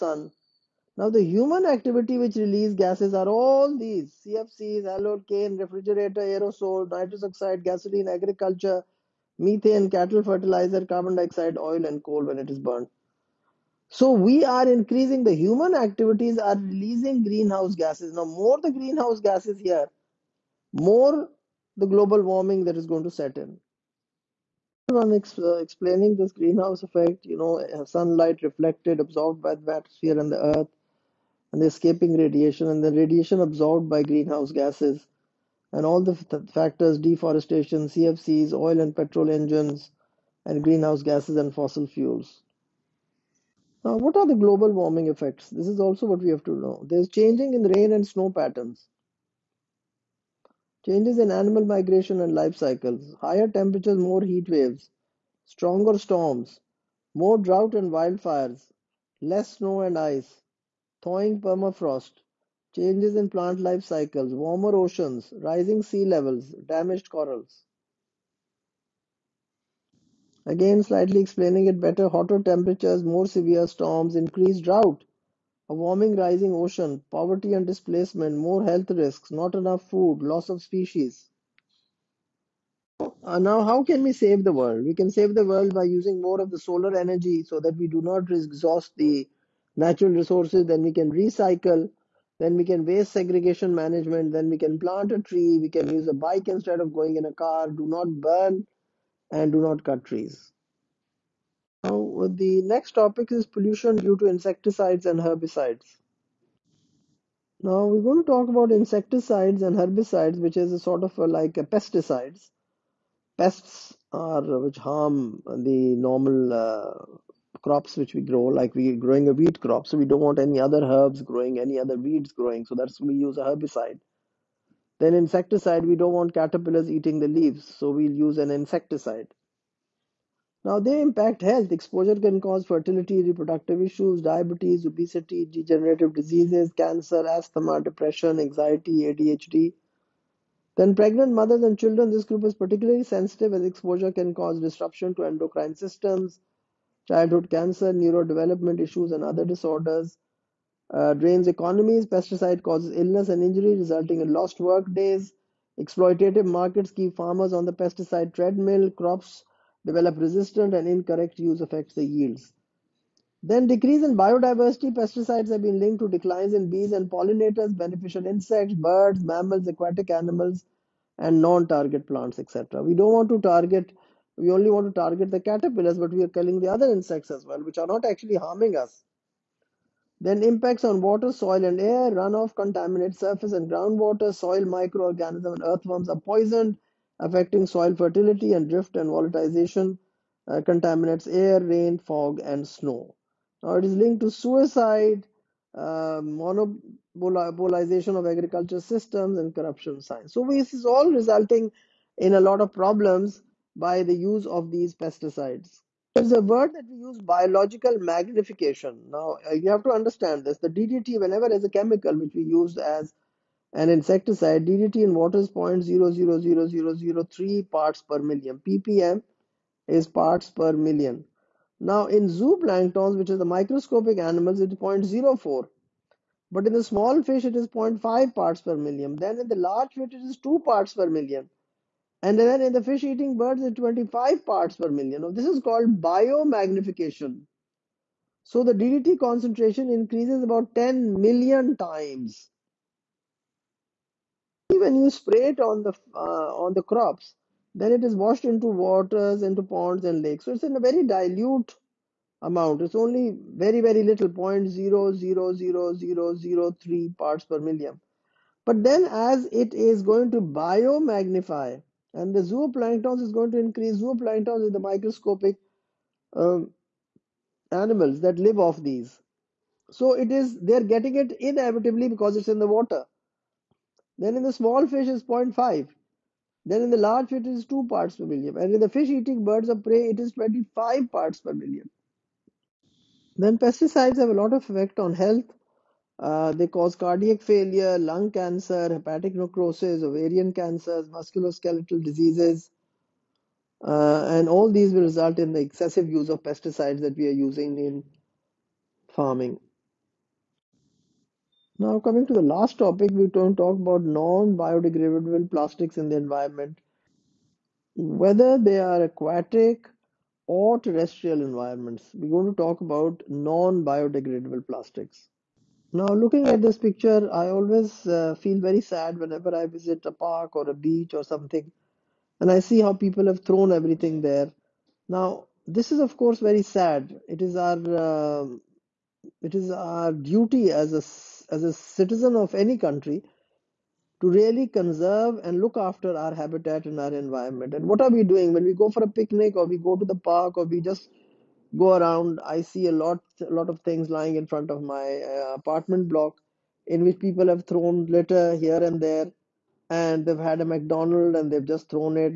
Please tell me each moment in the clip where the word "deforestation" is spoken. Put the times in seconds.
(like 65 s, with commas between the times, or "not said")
36 s.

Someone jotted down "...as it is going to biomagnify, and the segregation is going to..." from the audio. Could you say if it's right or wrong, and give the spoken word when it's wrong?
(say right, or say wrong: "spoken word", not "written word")
wrong: "zooplankton", not "segregation".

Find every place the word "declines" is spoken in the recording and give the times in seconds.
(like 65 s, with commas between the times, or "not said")
166 s.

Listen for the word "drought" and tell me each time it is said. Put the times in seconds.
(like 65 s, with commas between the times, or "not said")
57 s, 74 s.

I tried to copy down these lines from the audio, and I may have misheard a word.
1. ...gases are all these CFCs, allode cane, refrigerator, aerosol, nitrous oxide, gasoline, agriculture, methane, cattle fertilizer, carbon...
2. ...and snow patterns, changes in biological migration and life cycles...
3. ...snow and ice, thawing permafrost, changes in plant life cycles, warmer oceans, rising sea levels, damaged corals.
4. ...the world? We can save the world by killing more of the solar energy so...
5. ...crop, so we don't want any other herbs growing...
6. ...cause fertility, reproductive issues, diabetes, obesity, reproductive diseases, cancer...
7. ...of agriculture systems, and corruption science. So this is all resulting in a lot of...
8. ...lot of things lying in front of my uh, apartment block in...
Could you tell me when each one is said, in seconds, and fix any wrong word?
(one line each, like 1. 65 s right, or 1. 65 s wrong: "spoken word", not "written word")
1. 2 s right
2. 47 s wrong: "animal", not "biological"
3. 59 s right
4. 84 s wrong: "using", not "killing"
5. 119 s right
6. 132 s wrong: "degenerative", not "reproductive"
7. 198 s right
8. 343 s right.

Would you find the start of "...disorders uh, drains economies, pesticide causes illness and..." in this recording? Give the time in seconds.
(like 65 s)
149 s.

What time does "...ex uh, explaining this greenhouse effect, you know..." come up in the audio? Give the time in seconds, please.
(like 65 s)
25 s.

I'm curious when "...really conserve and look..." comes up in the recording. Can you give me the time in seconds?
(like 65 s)
334 s.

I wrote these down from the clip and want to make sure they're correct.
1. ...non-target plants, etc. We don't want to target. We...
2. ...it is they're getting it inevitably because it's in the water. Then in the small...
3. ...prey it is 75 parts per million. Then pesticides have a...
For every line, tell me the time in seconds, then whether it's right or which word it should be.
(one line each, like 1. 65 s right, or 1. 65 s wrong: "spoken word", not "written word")
1. 171 s right
2. 270 s right
3. 279 s wrong: "25", not "75".